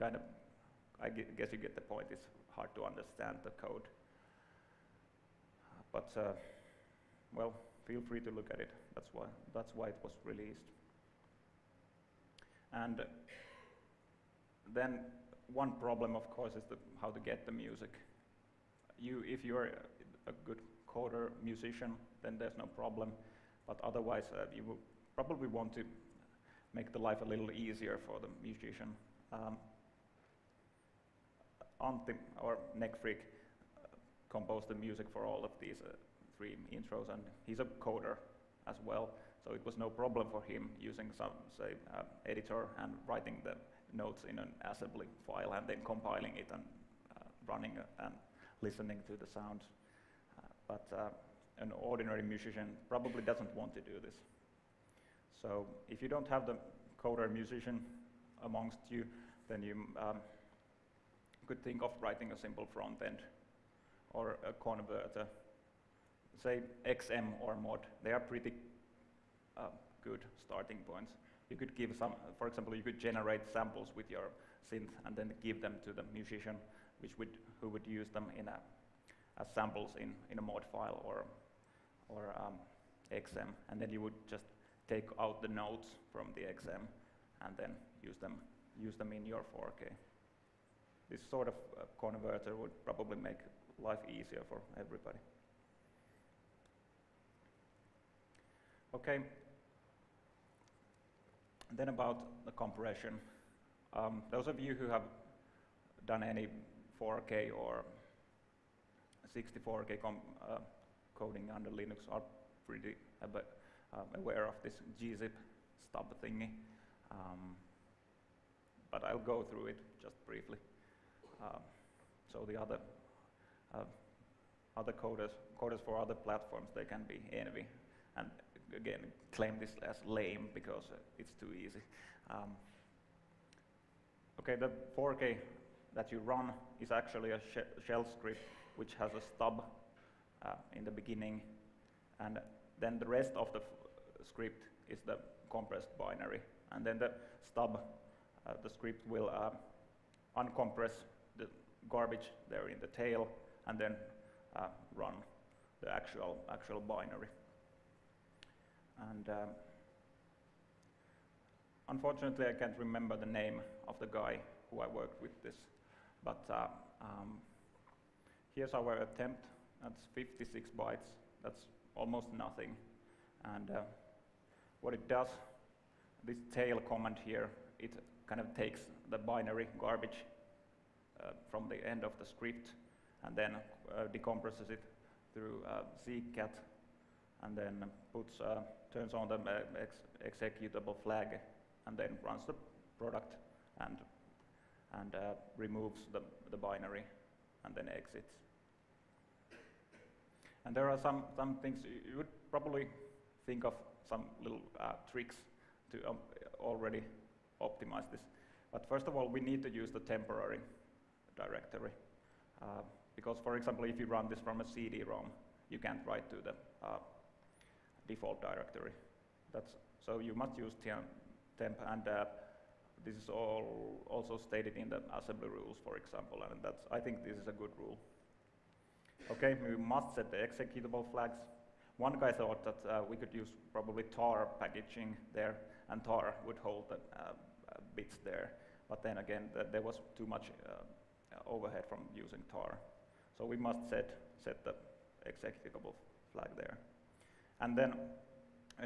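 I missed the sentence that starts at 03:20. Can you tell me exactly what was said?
And there are some, some things you would probably think of some little uh, tricks to um, already optimize this.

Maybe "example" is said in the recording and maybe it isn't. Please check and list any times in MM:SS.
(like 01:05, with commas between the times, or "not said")
01:12, 03:33, 03:45.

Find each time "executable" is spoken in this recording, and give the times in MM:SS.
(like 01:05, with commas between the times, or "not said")
03:10, 03:50, 04:05.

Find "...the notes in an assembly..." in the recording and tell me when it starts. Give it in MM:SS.
00:43.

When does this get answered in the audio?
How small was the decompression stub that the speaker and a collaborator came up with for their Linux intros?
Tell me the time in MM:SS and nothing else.
02:50.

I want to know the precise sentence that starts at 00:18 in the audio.
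You, if you're a, good coder, musician, then there's no problem.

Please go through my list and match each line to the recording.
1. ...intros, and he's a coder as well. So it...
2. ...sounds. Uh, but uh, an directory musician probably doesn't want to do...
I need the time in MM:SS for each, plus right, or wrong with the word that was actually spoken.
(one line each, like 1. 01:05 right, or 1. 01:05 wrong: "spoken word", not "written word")
1. 00:36 right
2. 00:49 wrong: "ordinary", not "directory".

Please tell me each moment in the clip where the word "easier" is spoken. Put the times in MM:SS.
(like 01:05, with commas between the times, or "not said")
00:27, 01:34.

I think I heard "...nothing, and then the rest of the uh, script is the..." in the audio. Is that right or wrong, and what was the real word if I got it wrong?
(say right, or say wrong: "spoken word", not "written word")
wrong: "beginning", not "nothing".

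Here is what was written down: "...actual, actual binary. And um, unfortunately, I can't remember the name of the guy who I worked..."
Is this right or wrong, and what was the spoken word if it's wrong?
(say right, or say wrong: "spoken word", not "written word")
right.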